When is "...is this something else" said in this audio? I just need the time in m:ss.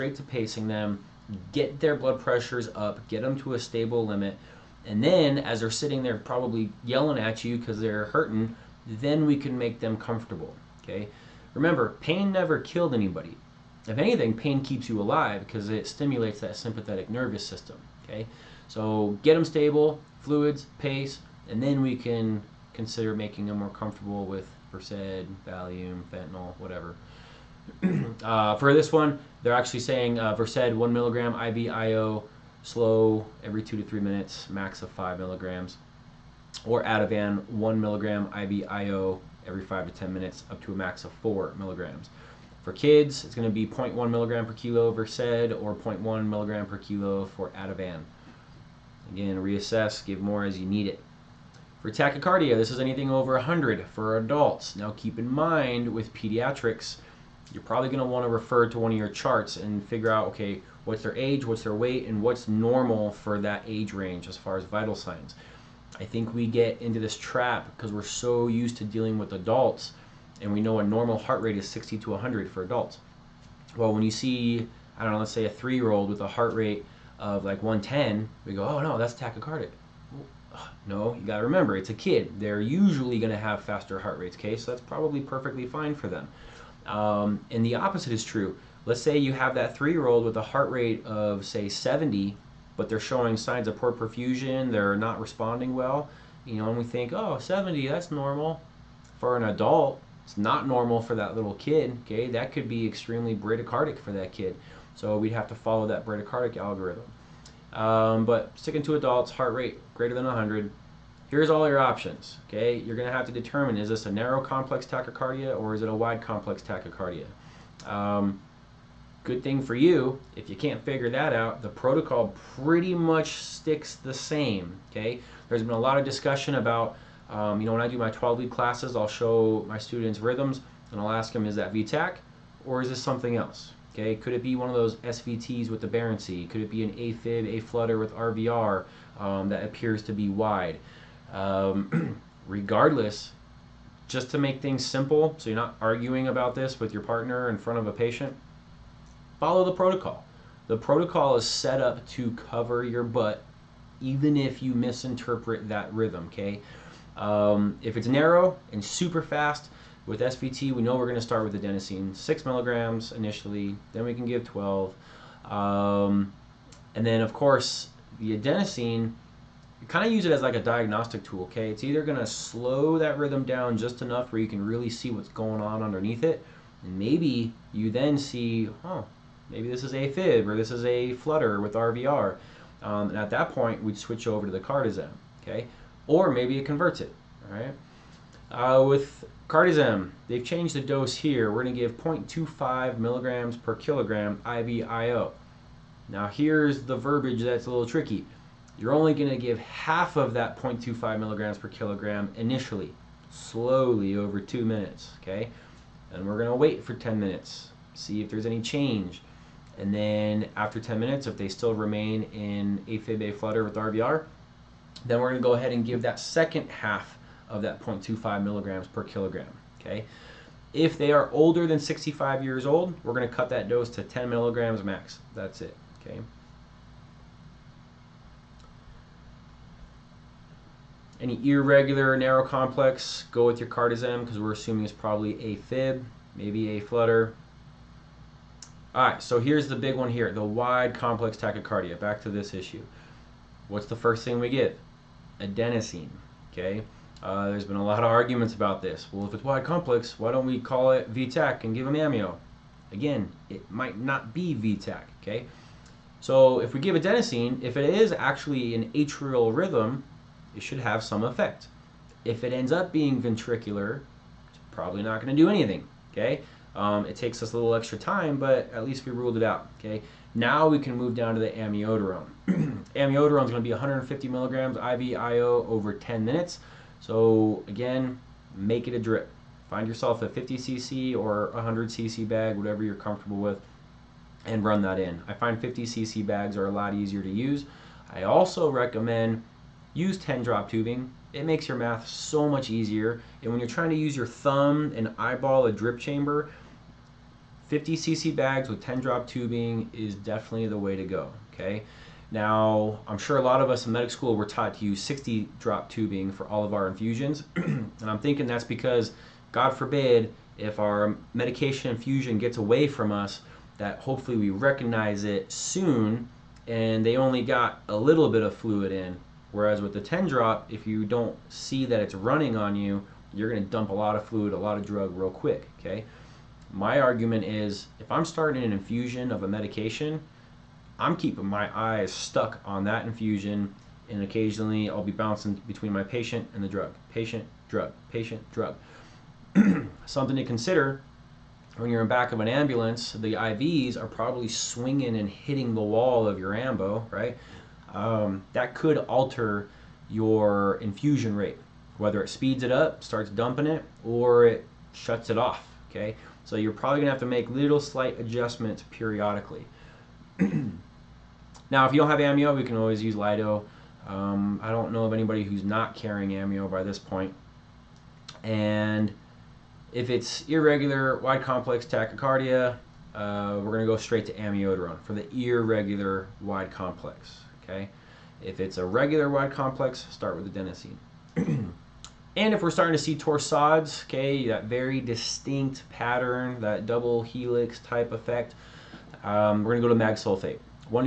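2:12.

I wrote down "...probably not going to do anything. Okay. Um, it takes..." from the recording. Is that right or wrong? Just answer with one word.
right.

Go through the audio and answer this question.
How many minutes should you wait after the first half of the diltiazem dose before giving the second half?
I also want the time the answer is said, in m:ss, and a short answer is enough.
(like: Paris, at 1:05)
10 minutes, at 3:26.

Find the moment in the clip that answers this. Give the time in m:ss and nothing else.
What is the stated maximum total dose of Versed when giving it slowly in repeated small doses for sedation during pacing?
0:34.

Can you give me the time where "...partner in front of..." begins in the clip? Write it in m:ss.
2:27.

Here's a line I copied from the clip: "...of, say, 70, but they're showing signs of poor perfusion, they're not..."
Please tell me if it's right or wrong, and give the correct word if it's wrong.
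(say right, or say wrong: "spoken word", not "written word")
right.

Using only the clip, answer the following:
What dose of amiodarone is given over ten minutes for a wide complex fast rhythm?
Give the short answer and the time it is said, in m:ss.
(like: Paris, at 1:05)
150 milligrams, at 4:33.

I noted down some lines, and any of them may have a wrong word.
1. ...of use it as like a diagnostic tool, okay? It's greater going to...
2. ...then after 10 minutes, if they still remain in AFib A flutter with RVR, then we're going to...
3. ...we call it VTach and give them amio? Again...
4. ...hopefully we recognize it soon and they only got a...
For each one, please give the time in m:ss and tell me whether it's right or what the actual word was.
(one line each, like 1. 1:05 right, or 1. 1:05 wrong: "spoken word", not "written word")
1. 2:50 wrong: "either", not "greater"
2. 3:29 right
3. 4:10 right
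4. 5:13 right.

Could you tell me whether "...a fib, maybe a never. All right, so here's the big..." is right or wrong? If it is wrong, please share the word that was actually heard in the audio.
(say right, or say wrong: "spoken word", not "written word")
wrong: "flutter", not "never".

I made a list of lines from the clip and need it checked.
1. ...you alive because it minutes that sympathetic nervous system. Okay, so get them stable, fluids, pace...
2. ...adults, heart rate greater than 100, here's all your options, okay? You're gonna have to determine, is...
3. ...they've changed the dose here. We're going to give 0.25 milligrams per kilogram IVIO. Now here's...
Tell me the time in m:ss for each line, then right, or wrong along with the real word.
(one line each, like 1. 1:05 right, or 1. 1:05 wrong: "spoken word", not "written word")
1. 0:14 wrong: "stimulates", not "minutes"
2. 1:48 right
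3. 3:10 right.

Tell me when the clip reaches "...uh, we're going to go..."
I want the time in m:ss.
6:13.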